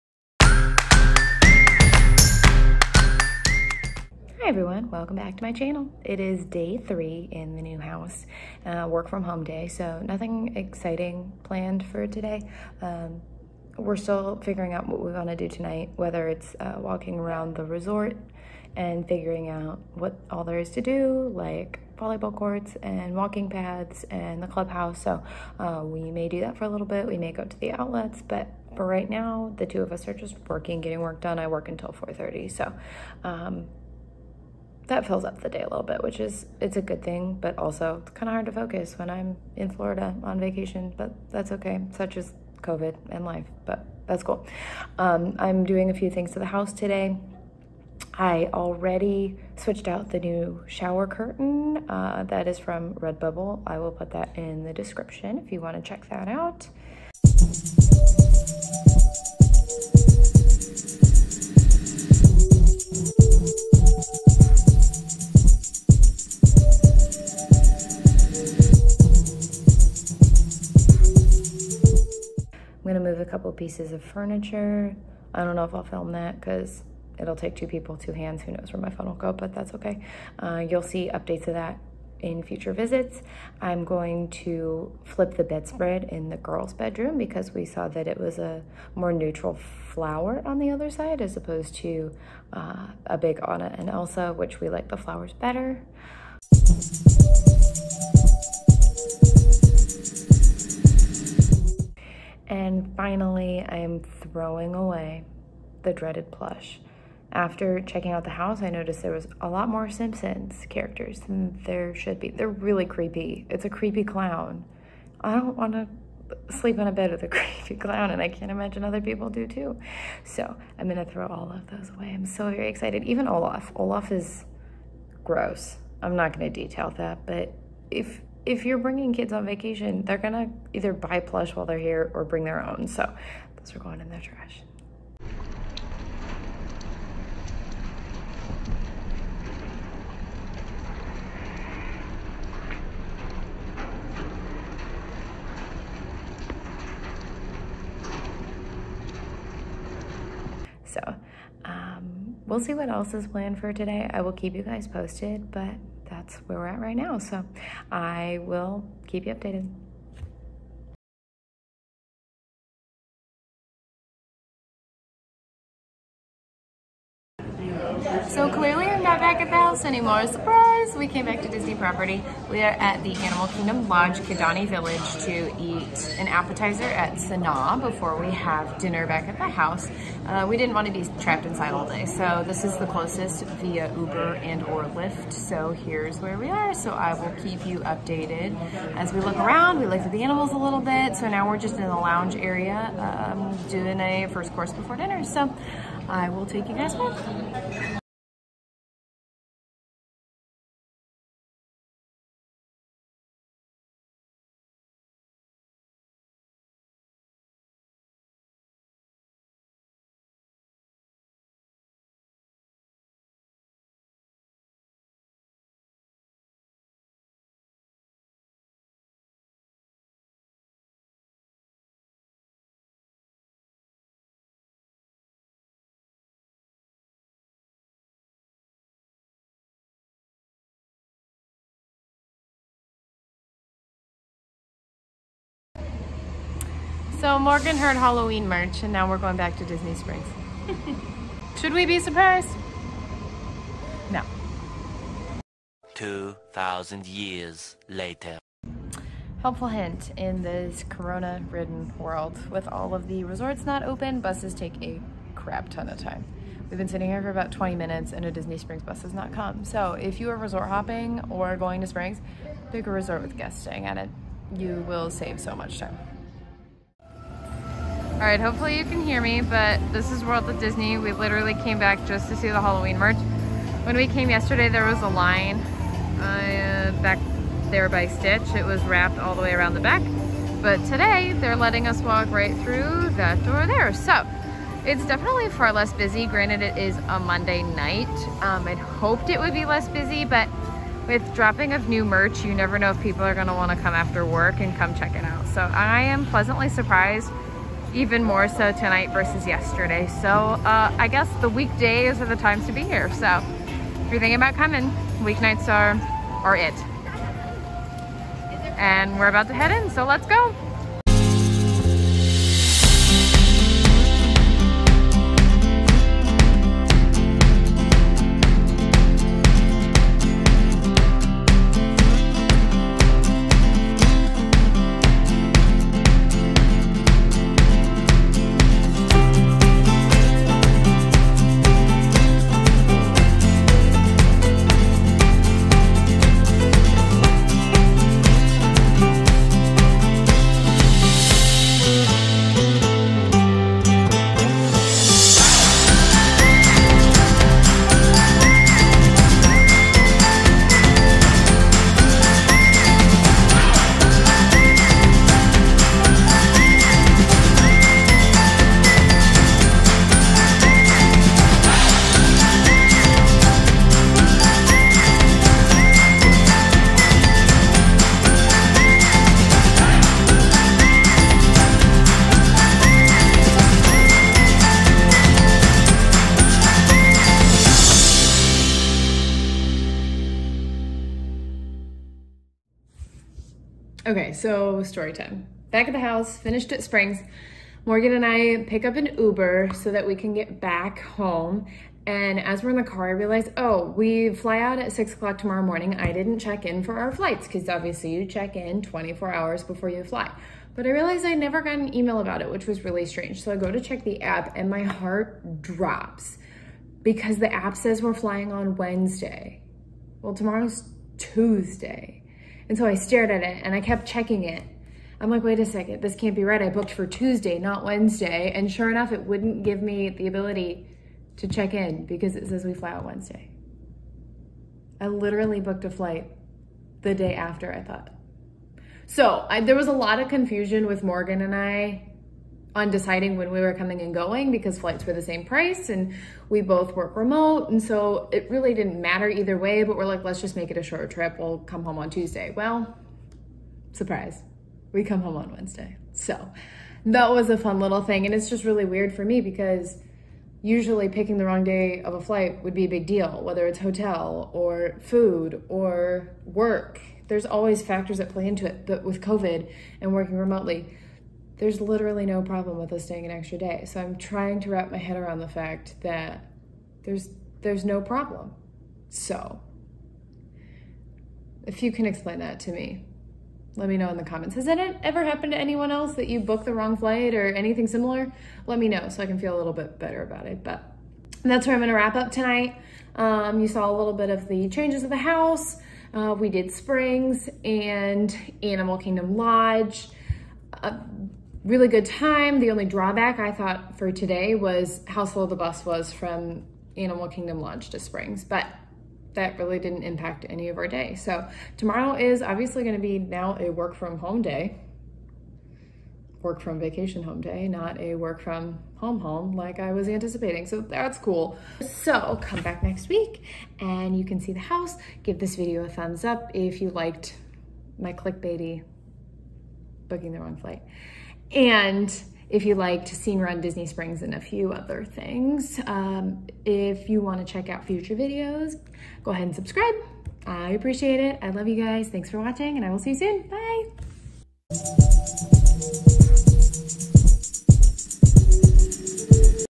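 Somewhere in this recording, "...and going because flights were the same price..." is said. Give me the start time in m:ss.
7:14.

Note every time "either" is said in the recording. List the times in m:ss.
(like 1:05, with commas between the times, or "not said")
2:10, 7:19.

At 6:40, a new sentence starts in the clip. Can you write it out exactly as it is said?
But I realized I never got an email about it, which was really strange.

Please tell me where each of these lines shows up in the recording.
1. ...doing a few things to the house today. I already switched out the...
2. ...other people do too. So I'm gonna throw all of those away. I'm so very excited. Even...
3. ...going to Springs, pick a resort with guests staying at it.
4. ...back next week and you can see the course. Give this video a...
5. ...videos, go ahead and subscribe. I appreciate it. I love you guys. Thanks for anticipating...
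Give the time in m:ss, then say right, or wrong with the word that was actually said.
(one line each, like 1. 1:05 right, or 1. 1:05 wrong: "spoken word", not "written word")
1. 0:45 right
2. 1:58 right
3. 4:21 right
4. 8:32 wrong: "house", not "course"
5. 8:48 wrong: "watching", not "anticipating".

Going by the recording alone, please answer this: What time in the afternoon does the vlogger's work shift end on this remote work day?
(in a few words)
4:30.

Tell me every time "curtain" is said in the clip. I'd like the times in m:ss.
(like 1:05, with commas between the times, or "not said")
0:51.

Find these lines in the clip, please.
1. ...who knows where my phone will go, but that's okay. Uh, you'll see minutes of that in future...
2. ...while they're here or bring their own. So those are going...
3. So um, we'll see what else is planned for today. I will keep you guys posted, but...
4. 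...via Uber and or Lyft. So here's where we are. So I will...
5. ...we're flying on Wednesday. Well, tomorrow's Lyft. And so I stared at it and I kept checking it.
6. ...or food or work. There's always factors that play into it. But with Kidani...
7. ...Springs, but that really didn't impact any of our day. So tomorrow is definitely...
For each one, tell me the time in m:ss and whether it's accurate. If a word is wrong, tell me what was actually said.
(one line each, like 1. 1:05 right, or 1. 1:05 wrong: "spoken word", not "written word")
1. 1:18 wrong: "updates", not "minutes"
2. 2:11 right
3. 2:30 right
4. 3:03 right
5. 6:48 wrong: "Tuesday", not "Lyft"
6. 7:34 wrong: "COVID", not "Kidani"
7. 8:17 wrong: "obviously", not "definitely".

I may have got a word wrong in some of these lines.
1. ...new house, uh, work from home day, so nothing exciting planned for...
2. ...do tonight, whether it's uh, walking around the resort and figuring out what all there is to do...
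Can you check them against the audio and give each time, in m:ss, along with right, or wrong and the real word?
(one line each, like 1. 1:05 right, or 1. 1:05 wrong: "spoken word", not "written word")
1. 0:07 right
2. 0:15 right.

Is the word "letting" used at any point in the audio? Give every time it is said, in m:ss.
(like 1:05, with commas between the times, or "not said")
4:41.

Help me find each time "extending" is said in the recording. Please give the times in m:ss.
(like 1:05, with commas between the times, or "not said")
not said.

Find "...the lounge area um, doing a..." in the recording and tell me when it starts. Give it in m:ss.
3:11.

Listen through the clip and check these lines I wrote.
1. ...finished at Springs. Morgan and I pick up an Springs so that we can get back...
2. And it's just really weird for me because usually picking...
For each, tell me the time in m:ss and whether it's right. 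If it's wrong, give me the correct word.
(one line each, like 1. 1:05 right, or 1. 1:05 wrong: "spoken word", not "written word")
1. 6:26 wrong: "Uber", not "Springs"
2. 7:28 right.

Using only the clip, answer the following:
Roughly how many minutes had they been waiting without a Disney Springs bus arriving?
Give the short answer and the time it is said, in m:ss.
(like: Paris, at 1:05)
20, at 4:17.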